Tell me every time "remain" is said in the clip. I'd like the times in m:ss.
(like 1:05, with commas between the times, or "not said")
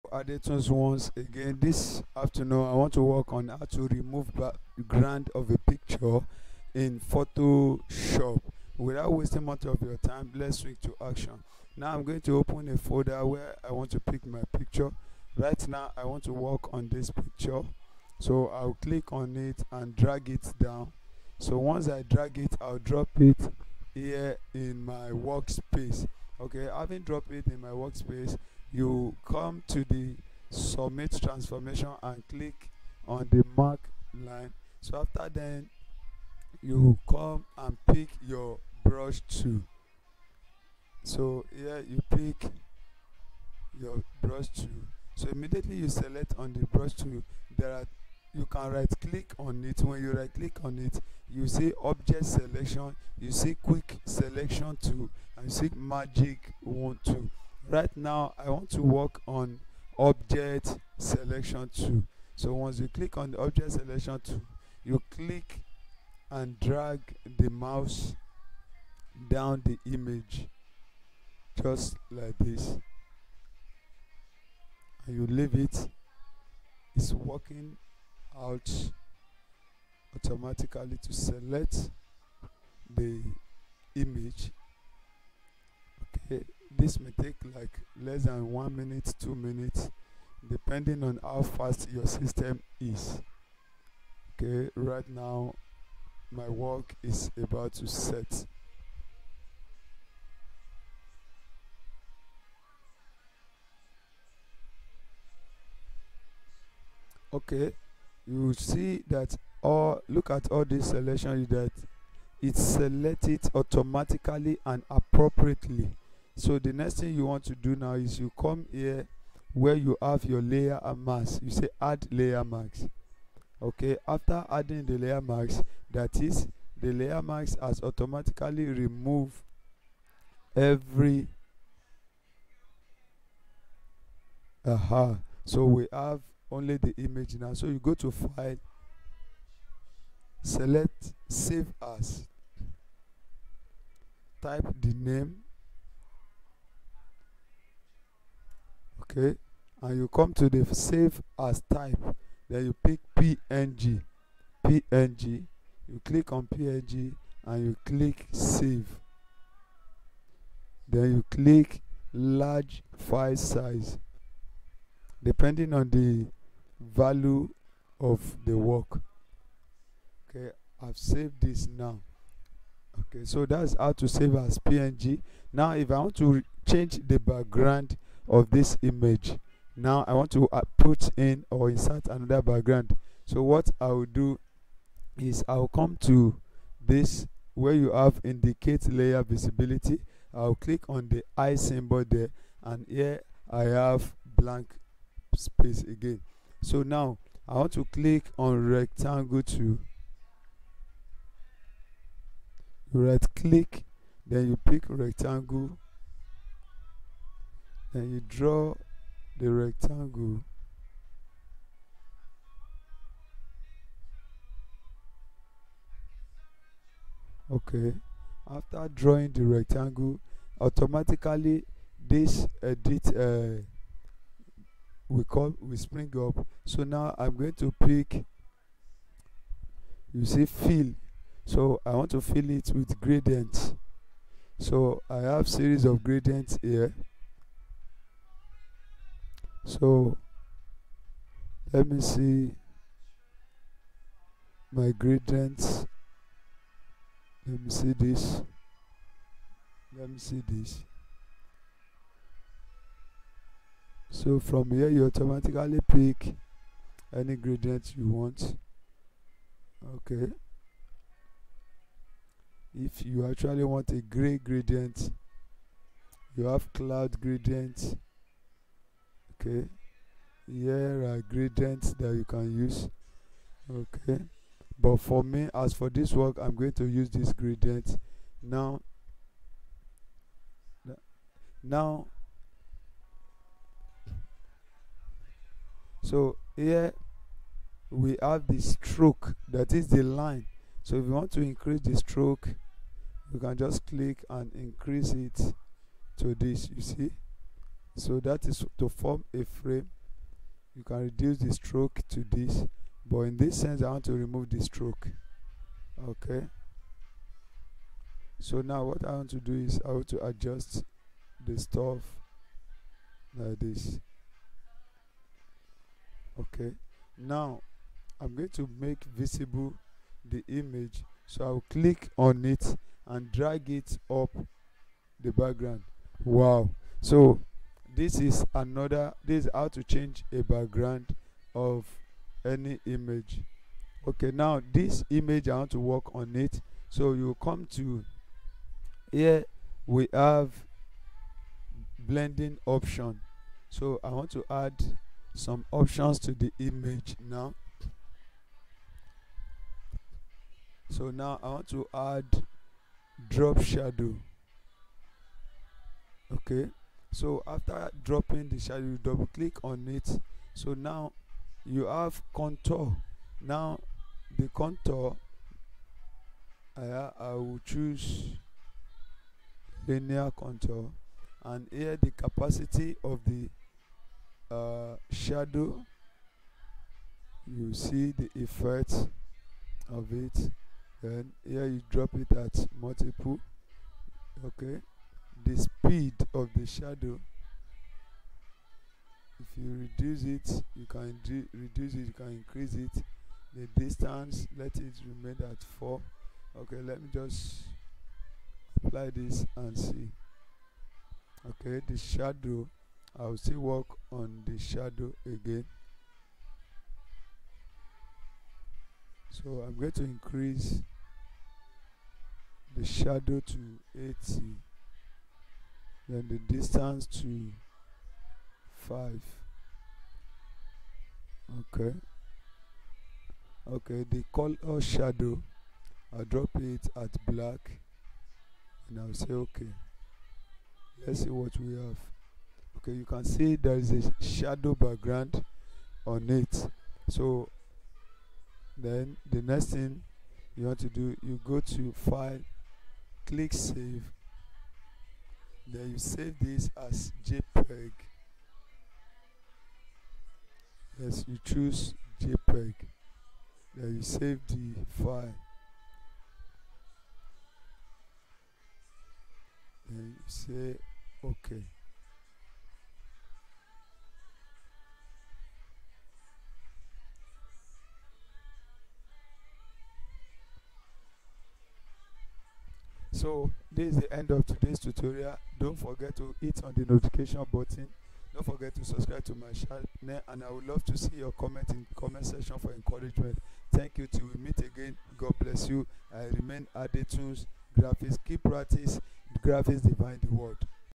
6:35, 8:06.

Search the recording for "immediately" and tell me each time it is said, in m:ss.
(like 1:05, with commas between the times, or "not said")
0:45.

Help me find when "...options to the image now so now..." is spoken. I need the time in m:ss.
5:45.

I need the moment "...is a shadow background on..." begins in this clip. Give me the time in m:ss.
7:13.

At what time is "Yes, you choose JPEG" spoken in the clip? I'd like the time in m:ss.
7:31.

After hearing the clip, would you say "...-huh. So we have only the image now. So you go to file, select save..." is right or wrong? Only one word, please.
right.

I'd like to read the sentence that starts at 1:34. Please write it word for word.
Okay, right now my work is about to set.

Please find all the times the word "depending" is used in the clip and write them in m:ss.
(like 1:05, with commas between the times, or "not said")
1:30, 2:45.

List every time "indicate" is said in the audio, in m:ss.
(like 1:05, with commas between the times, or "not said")
3:08.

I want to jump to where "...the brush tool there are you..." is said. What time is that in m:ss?
0:46.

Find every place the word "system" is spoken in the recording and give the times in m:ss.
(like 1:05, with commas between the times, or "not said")
1:32.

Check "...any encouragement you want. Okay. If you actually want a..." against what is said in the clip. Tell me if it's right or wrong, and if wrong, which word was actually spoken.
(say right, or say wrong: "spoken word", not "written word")
wrong: "gradient", not "encouragement".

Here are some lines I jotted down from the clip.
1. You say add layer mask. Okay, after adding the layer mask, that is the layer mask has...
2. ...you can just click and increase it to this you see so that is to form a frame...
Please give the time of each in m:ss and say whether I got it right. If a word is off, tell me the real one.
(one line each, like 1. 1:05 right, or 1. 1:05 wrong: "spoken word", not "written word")
1. 2:01 right
2. 4:53 right.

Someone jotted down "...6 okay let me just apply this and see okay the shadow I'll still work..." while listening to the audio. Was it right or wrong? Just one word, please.
wrong.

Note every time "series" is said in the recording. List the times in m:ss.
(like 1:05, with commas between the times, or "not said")
3:55.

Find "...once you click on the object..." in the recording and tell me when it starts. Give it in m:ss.
1:02.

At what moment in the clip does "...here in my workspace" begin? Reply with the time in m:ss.
0:23.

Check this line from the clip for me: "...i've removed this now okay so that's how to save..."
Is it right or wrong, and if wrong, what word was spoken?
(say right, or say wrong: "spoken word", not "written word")
wrong: "saved", not "removed".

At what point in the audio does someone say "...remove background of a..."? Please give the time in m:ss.
0:03.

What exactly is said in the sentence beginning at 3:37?
Okay, after drawing the rectangle, automatically this edit uh, we call we spring up.